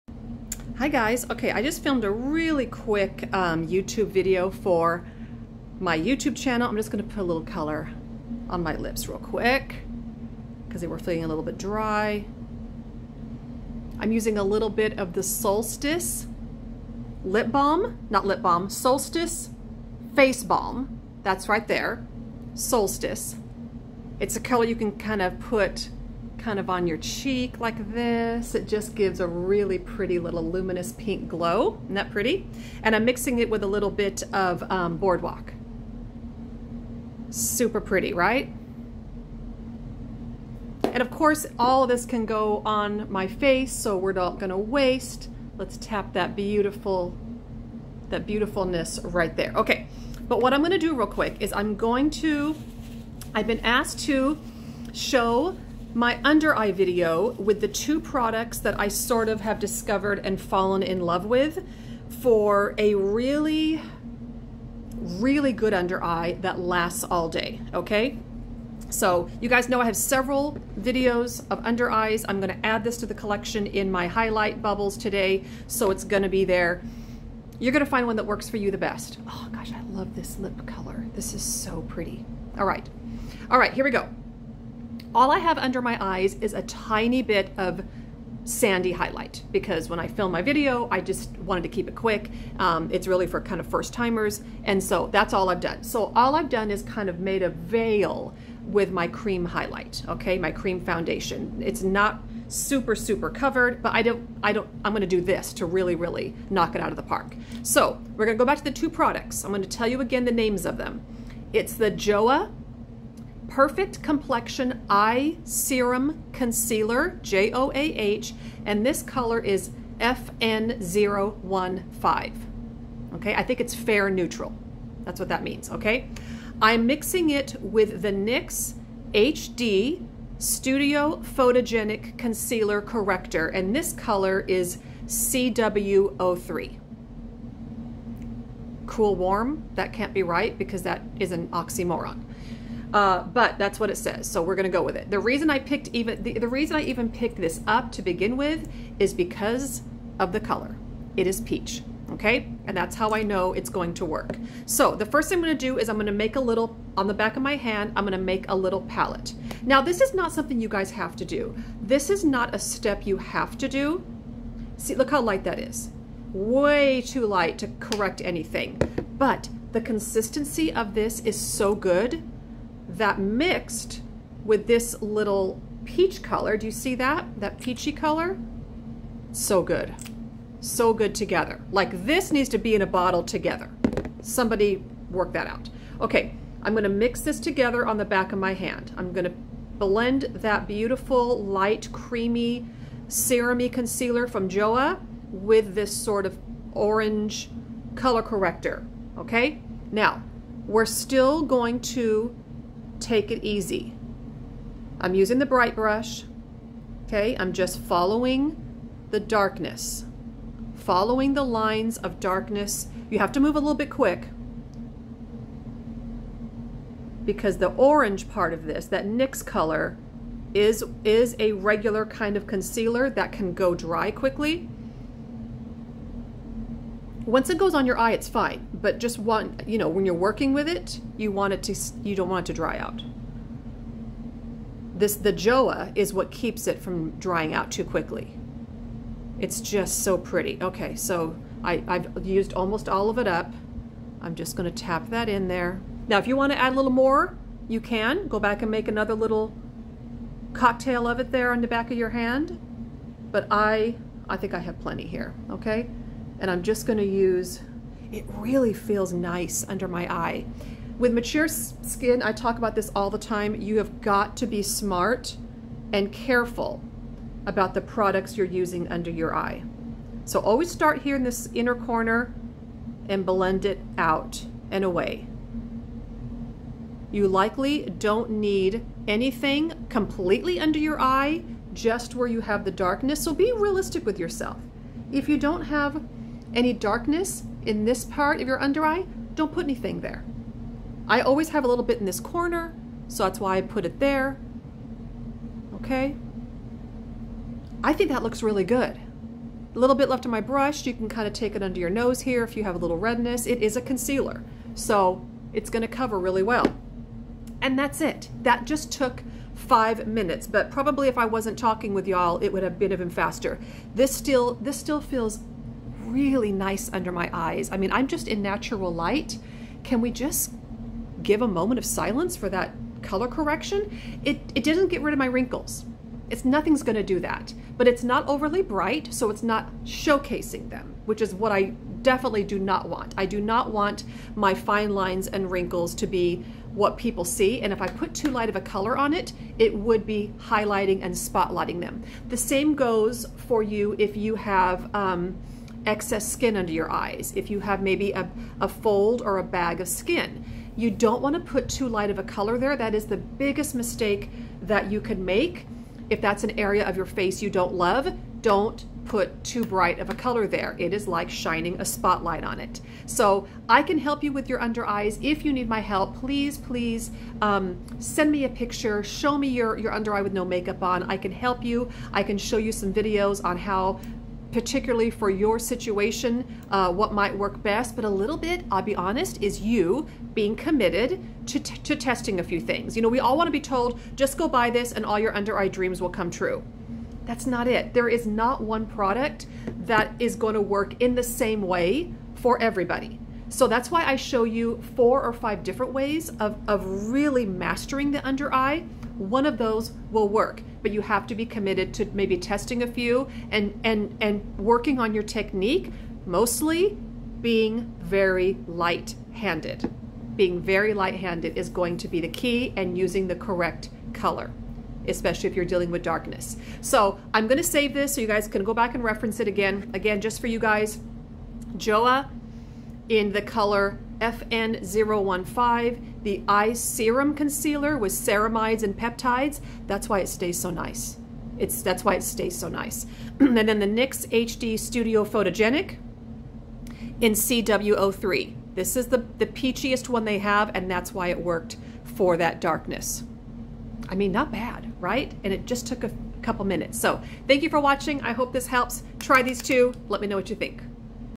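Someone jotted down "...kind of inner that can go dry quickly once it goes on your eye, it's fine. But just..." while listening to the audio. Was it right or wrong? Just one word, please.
wrong.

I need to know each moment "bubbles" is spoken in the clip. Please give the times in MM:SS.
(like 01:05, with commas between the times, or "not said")
01:14.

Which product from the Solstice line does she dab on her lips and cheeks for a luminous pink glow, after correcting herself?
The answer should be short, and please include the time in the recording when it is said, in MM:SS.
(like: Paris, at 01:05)
face balm, at 00:18.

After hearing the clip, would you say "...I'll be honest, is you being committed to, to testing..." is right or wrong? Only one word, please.
right.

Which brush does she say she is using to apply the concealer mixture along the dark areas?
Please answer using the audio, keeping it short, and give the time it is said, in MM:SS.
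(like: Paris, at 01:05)
bright brush, at 03:25.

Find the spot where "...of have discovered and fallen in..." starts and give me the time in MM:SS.
00:59.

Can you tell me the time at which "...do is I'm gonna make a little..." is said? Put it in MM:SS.
02:35.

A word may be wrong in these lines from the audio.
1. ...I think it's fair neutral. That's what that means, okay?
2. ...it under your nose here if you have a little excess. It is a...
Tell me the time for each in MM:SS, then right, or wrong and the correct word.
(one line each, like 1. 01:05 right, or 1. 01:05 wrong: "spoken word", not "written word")
1. 02:03 right
2. 05:01 wrong: "redness", not "excess".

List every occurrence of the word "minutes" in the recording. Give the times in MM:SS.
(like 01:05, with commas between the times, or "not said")
05:10, 07:26.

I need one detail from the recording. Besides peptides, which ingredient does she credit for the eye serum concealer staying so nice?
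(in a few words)
ceramides.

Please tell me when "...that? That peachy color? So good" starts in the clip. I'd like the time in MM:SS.
02:56.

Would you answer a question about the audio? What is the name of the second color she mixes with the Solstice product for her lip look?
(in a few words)
Boardwalk.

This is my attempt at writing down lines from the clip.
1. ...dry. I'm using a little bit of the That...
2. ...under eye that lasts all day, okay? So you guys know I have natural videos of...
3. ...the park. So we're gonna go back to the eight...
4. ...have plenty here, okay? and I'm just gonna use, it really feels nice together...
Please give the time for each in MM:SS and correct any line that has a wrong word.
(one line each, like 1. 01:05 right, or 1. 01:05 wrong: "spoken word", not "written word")
1. 00:11 wrong: "Solstice", not "That"
2. 01:05 wrong: "several", not "natural"
3. 01:46 wrong: "two", not "eight"
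4. 04:14 wrong: "under", not "together".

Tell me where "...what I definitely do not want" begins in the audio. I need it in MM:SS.
05:31.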